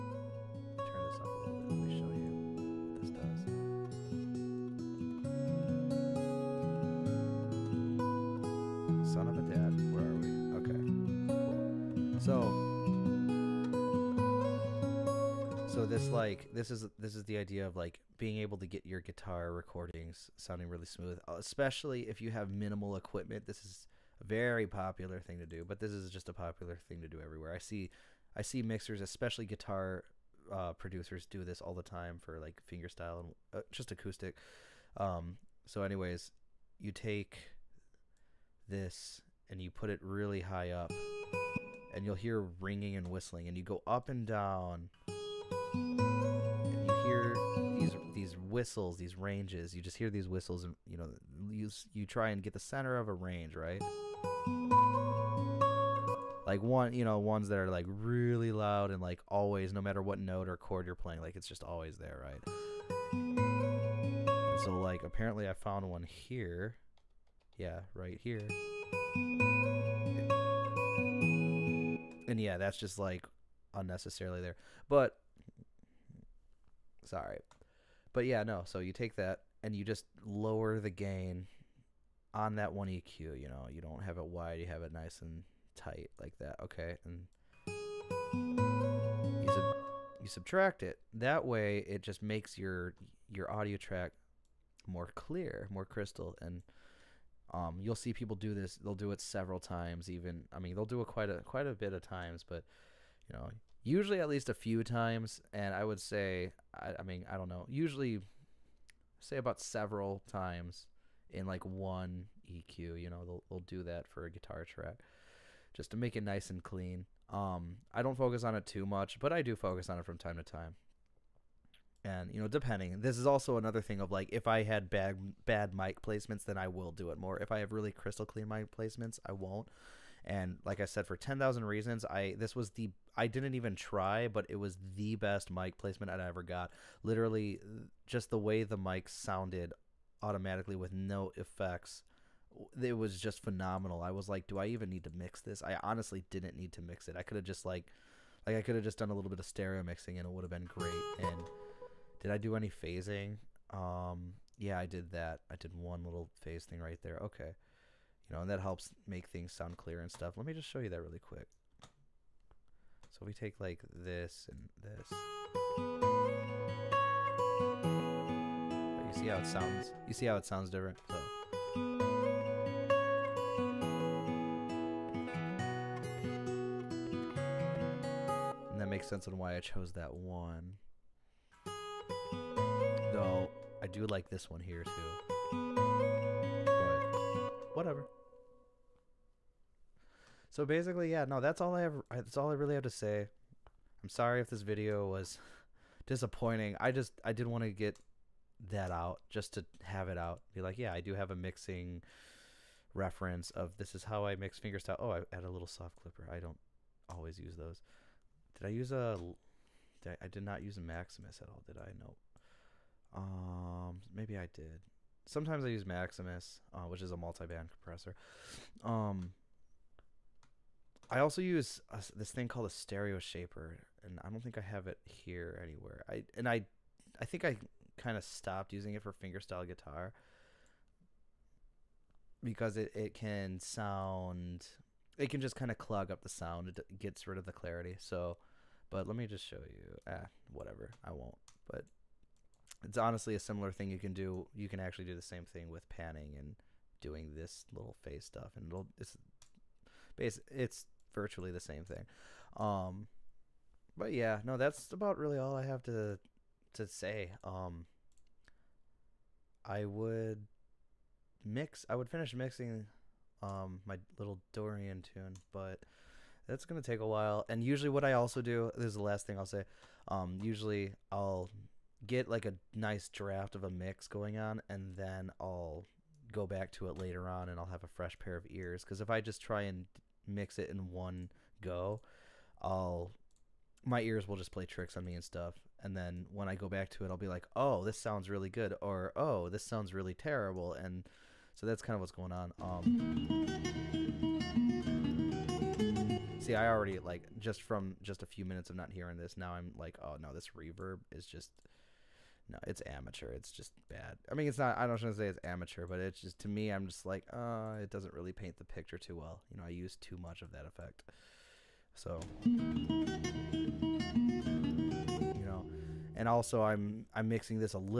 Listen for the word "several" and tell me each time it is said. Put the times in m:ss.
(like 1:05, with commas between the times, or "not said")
1:39, 1:49.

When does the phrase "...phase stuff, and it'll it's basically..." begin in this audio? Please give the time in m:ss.
4:08.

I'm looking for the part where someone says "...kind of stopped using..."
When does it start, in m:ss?
3:47.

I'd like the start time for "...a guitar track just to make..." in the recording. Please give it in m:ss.
1:54.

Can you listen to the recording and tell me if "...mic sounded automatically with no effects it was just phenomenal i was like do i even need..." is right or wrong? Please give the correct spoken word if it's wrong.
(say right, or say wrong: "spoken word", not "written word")
right.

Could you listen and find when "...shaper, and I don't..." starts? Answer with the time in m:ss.
3:43.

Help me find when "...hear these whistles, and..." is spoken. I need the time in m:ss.
0:49.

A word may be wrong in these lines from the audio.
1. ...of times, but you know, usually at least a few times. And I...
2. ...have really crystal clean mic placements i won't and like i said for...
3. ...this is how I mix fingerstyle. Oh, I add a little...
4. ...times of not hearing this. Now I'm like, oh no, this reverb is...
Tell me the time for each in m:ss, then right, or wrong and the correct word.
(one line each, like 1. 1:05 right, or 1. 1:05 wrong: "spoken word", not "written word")
1. 1:41 right
2. 2:07 right
3. 3:23 right
4. 4:58 wrong: "minutes", not "times".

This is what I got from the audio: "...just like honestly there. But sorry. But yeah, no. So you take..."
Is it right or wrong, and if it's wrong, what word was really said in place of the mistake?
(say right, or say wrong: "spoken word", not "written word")
wrong: "unnecessarily", not "honestly".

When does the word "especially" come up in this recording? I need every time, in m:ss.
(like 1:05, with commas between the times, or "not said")
0:21, 0:29.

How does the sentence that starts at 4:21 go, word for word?
I would finish mixing um, my little Dorian tune, but that's gonna take a while.